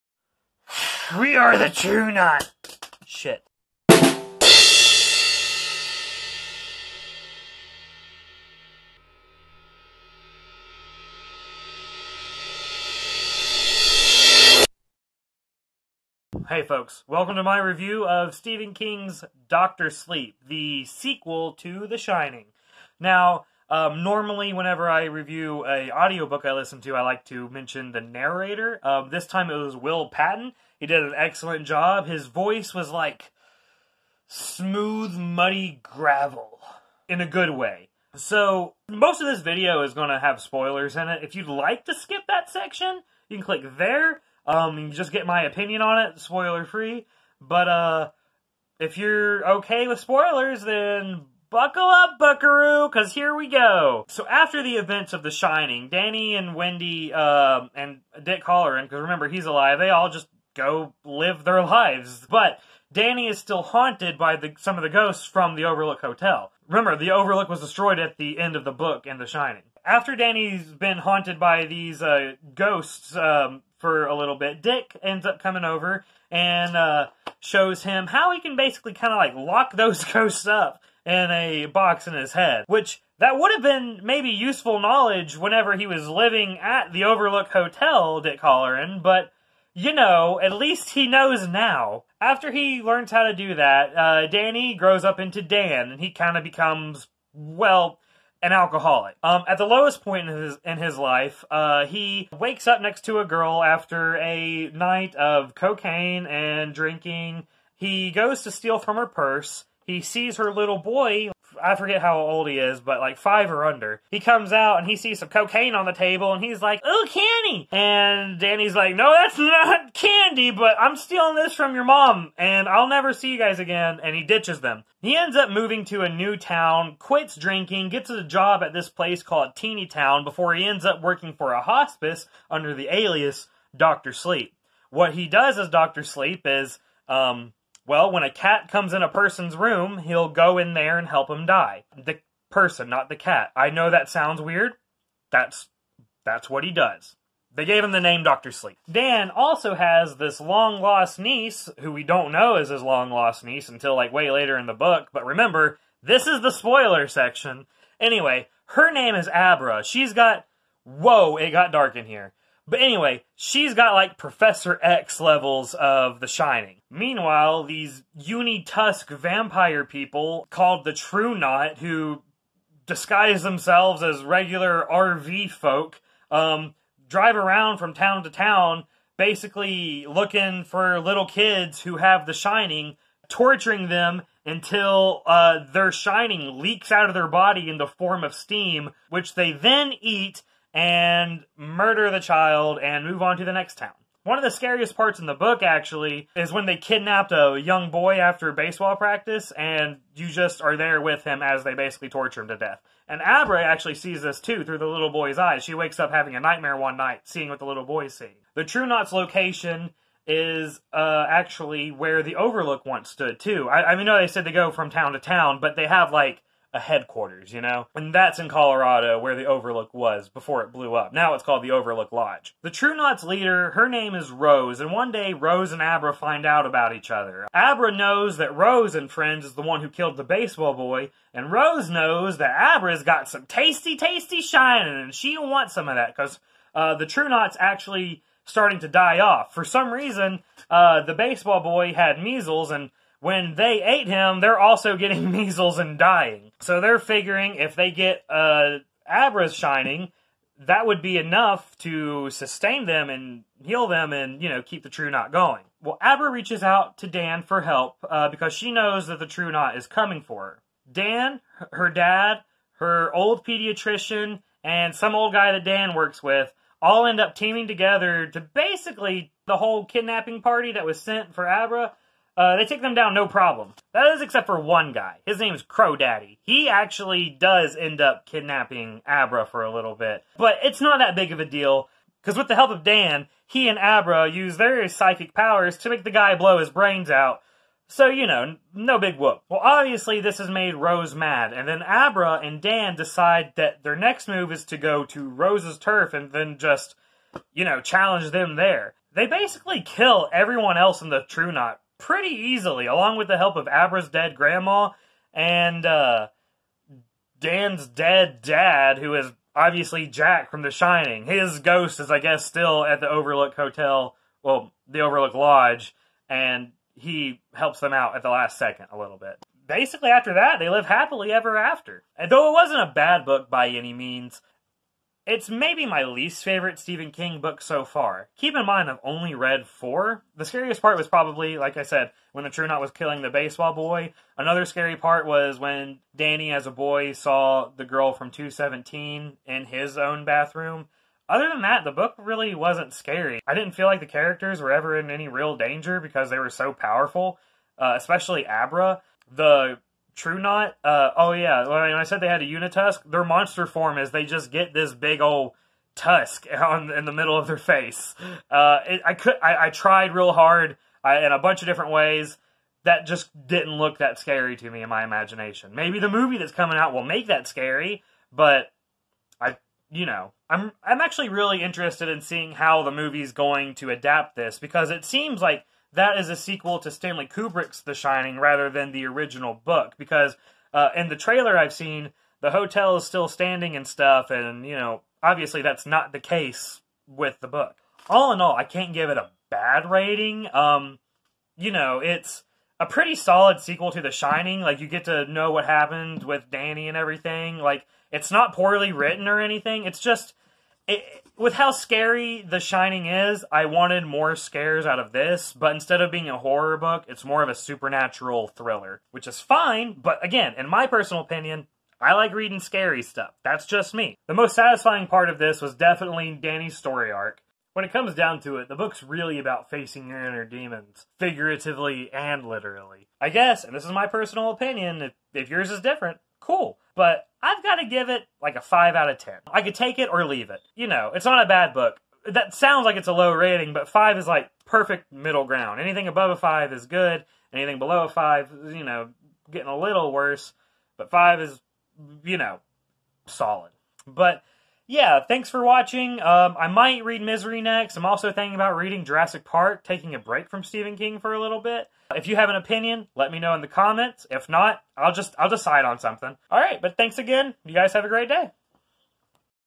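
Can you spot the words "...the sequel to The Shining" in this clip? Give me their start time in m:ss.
0:20.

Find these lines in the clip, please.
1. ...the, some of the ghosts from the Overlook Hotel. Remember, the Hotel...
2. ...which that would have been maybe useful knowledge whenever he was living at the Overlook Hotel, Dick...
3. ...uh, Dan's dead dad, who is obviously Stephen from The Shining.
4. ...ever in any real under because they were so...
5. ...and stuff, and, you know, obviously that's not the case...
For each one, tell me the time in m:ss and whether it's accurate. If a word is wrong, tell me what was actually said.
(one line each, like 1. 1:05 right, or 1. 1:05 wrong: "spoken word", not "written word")
1. 1:04 wrong: "Overlook", not "Hotel"
2. 1:22 right
3. 5:05 wrong: "Jack", not "Stephen"
4. 5:44 wrong: "danger", not "under"
5. 6:23 right.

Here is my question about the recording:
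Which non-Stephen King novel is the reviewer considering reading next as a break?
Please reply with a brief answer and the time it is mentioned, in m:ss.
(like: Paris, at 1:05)
Jurassic Park, at 7:29.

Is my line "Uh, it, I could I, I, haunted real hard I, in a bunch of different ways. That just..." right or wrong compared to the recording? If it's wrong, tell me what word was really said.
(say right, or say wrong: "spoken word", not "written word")
wrong: "tried", not "haunted".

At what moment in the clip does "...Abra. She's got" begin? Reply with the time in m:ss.
2:39.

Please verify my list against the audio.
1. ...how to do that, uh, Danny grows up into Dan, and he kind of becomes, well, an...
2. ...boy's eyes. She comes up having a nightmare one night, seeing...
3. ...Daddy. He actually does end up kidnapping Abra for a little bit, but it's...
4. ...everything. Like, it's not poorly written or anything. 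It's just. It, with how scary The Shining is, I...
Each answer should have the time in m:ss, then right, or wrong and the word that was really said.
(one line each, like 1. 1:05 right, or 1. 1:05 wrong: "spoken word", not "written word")
1. 1:33 right
2. 3:25 wrong: "wakes", not "comes"
3. 4:35 right
4. 6:36 right.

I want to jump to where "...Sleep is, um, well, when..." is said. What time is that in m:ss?
2:16.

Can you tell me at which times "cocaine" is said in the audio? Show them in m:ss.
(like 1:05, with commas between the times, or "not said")
1:45, 1:55.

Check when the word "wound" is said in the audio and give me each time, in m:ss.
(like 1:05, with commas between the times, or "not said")
not said.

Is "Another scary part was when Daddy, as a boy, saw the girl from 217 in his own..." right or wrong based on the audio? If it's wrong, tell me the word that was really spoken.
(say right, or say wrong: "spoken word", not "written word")
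wrong: "Danny", not "Daddy".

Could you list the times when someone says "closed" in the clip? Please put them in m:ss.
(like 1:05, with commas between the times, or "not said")
not said.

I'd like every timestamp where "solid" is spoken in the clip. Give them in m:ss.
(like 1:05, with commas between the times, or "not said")
6:33, 7:23.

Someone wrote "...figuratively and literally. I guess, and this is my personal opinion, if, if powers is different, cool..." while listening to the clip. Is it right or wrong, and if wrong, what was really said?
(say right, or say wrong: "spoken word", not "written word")
wrong: "yours", not "powers".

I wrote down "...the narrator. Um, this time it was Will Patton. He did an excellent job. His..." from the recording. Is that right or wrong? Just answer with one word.
right.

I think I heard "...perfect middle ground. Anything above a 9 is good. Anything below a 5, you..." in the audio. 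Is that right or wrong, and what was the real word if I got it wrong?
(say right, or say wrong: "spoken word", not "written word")
wrong: "5", not "9".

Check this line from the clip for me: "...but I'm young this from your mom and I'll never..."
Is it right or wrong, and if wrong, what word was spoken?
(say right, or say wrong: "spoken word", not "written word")
wrong: "stealing", not "young".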